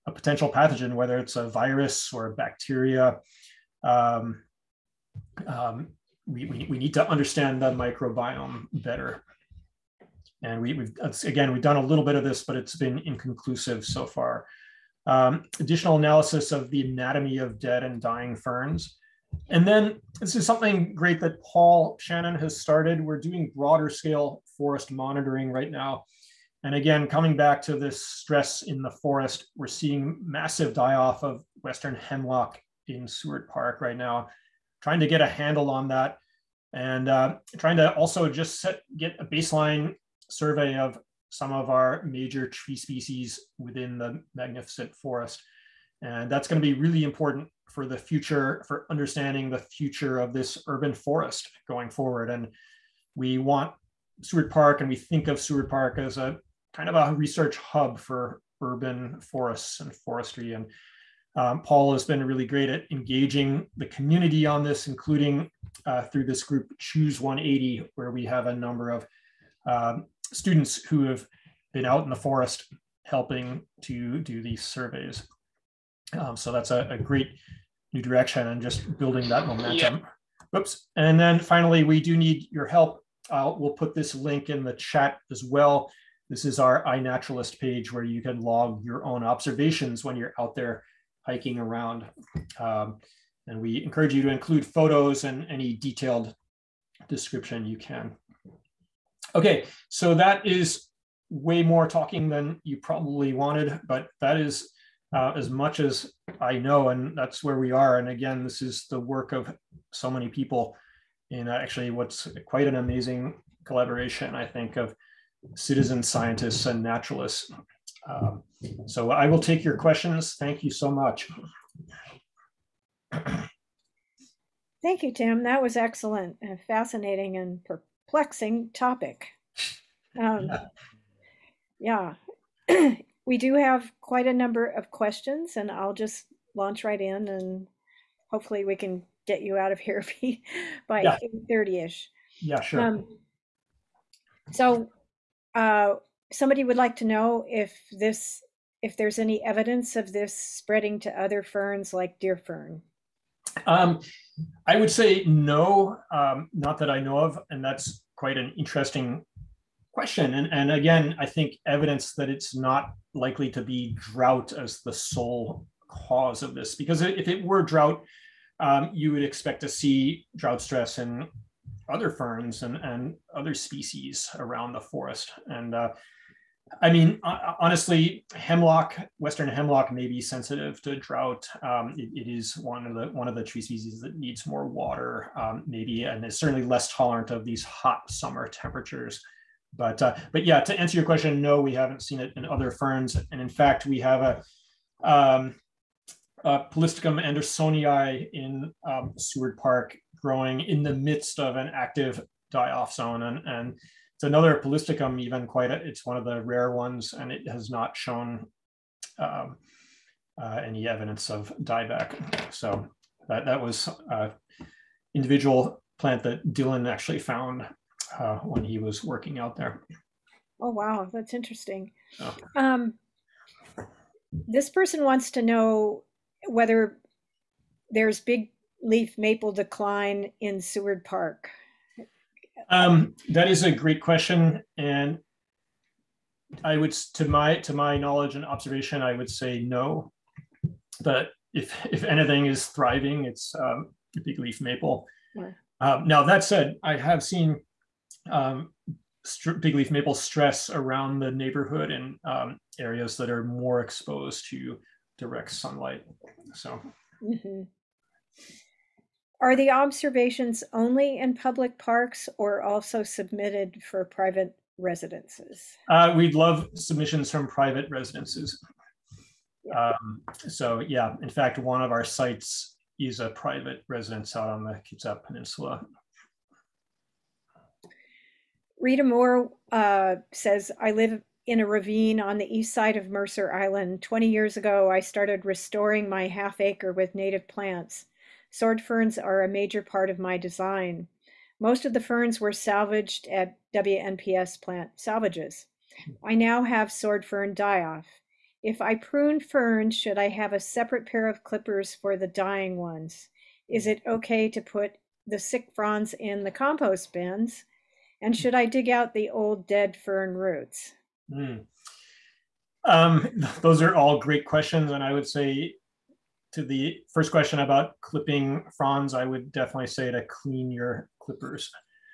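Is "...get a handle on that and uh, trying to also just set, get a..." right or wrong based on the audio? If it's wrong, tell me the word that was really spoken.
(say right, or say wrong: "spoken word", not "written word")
right.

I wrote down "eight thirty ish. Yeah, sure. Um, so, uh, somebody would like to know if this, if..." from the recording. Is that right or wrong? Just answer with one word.
right.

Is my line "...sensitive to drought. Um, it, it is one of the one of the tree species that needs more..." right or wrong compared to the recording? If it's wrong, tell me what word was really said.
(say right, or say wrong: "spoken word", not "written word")
right.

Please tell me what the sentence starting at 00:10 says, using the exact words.
And we, have again, we've done a little bit of this, but it's been inconclusive so far.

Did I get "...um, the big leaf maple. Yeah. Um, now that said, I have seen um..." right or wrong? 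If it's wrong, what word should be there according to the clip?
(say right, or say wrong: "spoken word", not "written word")
right.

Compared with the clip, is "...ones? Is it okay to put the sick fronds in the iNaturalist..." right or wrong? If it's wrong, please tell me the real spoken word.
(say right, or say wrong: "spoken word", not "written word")
wrong: "compost", not "iNaturalist".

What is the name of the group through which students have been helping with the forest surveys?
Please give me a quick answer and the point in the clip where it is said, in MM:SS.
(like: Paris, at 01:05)
Choose 180, at 01:06.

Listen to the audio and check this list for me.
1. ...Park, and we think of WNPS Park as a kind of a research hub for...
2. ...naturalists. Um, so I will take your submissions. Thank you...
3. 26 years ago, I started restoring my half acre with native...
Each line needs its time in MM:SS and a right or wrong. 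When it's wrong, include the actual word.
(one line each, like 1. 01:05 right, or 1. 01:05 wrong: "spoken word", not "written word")
1. 00:54 wrong: "Seward", not "WNPS"
2. 01:56 wrong: "questions", not "submissions"
3. 04:44 wrong: "20", not "26".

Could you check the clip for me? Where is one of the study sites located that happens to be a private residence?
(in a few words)
Kitsap Peninsula.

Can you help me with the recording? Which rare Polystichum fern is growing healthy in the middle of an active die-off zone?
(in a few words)
andersonii.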